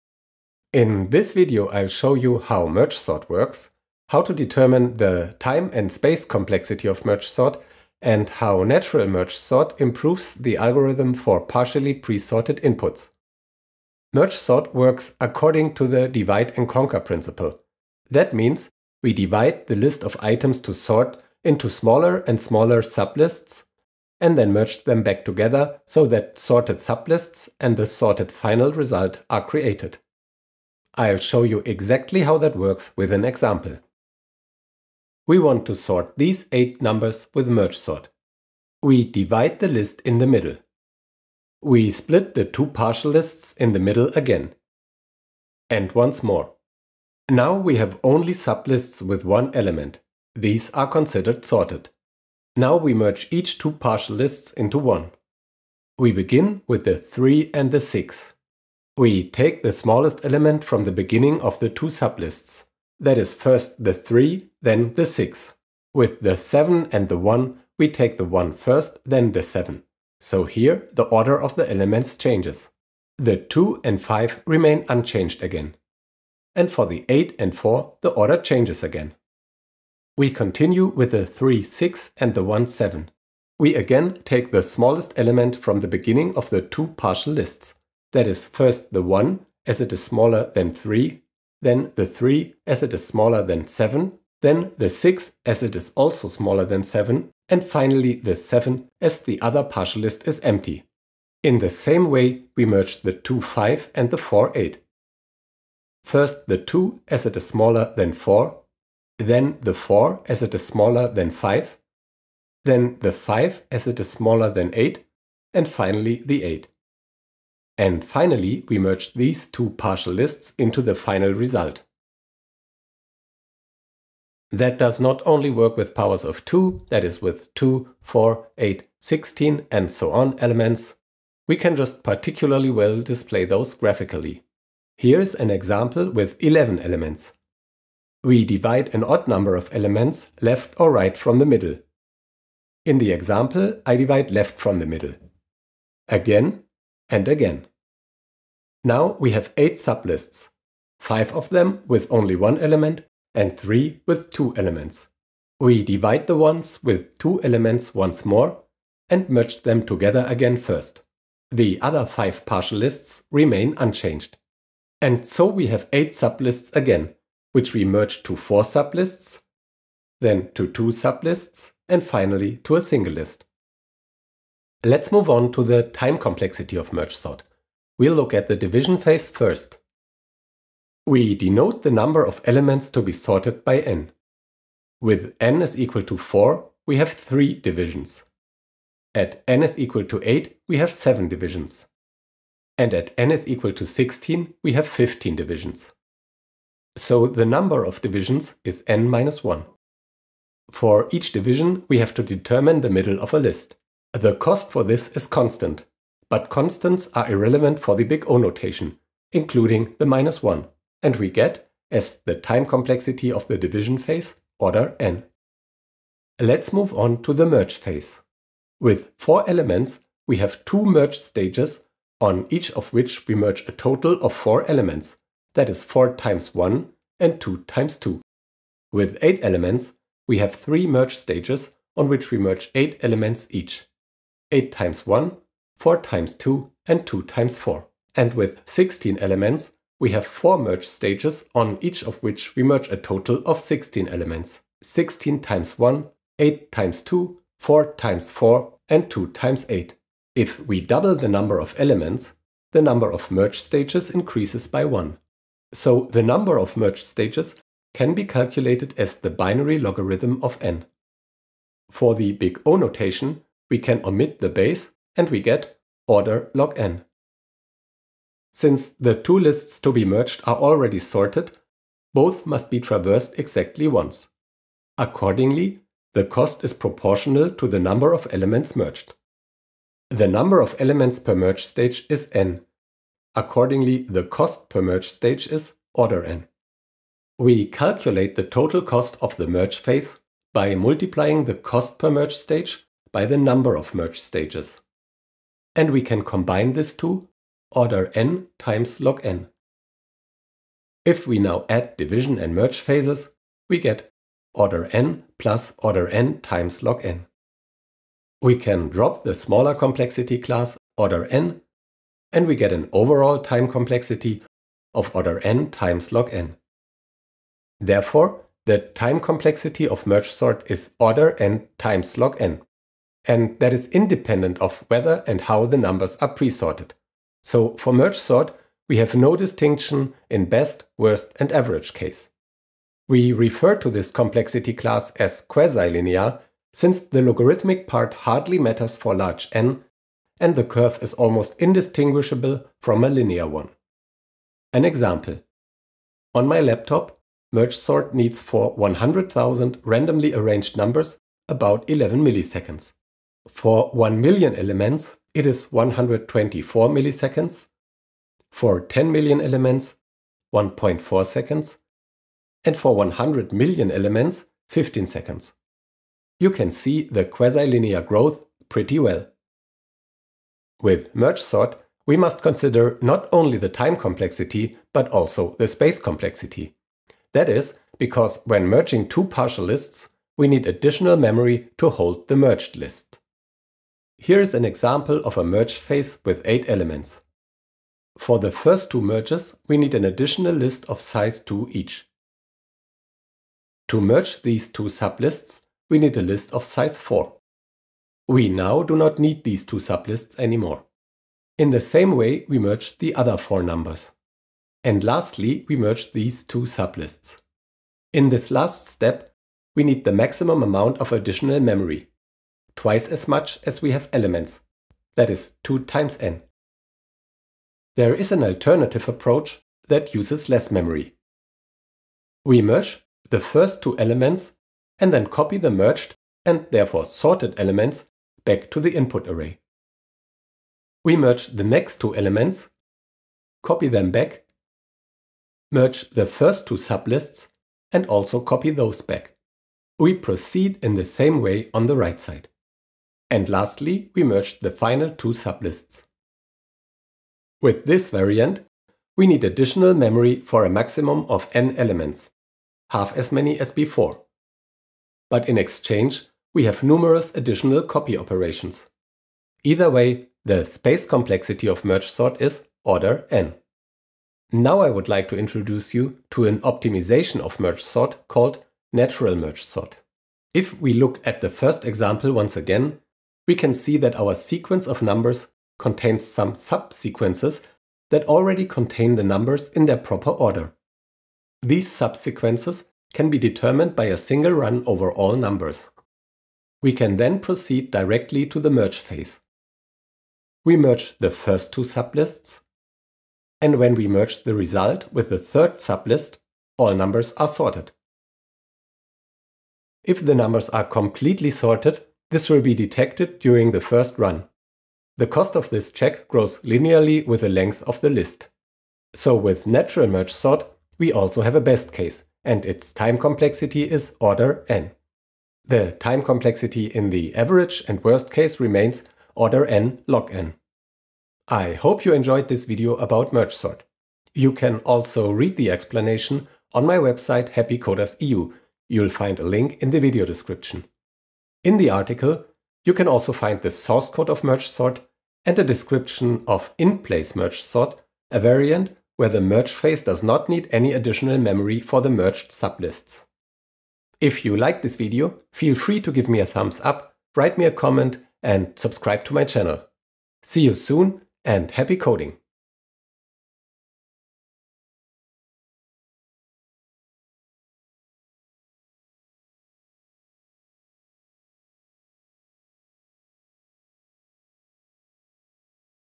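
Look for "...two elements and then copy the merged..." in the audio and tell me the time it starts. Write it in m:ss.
7:03.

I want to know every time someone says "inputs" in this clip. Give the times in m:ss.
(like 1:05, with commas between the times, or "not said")
0:12, 7:08.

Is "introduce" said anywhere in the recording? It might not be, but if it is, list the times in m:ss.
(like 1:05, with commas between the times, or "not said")
7:45.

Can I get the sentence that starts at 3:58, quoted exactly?
And with 16 elements, we have 4 merge stages on each of which we merge a total of 16 elements.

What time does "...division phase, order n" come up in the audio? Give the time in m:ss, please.
3:33.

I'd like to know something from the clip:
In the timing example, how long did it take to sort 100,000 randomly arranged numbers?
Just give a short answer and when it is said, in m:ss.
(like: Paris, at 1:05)
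11 milliseconds, at 5:51.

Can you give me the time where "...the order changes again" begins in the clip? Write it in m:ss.
1:18.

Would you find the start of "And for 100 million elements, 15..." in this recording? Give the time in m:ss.
6:02.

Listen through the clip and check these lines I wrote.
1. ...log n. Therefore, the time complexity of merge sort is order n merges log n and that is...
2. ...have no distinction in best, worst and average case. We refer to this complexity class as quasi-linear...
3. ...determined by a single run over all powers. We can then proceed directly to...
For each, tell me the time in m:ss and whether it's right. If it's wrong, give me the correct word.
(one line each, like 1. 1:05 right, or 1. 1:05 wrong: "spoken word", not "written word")
1. 5:16 wrong: "times", not "merges"
2. 5:28 right
3. 8:03 wrong: "numbers", not "powers".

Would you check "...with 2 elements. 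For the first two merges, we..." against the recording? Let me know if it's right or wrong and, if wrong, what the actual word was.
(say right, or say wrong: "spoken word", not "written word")
wrong: "8", not "2".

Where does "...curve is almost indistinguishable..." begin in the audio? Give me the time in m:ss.
5:40.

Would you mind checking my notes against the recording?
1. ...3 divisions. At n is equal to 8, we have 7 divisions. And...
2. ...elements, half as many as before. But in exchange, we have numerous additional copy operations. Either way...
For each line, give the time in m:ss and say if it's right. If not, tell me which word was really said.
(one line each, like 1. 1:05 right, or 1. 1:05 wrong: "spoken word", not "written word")
1. 3:07 right
2. 7:31 right.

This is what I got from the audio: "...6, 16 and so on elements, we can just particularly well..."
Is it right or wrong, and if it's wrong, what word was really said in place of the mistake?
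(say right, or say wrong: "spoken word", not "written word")
wrong: "8", not "6".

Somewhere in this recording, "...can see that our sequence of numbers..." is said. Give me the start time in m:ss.
7:53.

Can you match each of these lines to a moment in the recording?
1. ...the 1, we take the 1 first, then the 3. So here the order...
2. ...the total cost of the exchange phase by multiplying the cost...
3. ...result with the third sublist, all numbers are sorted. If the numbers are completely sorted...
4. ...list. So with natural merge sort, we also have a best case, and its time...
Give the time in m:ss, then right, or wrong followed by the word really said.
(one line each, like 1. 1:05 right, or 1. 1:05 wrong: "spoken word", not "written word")
1. 1:07 wrong: "7", not "3"
2. 4:48 wrong: "merge", not "exchange"
3. 8:14 right
4. 8:28 right.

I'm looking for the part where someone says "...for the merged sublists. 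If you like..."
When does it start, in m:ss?
9:01.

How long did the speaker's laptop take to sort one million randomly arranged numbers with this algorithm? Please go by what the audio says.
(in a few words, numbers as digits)
124 milliseconds.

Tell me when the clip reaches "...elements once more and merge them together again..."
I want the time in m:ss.
2:37.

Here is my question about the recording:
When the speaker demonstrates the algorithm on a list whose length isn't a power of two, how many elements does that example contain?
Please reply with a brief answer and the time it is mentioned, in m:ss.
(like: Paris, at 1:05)
11, at 2:16.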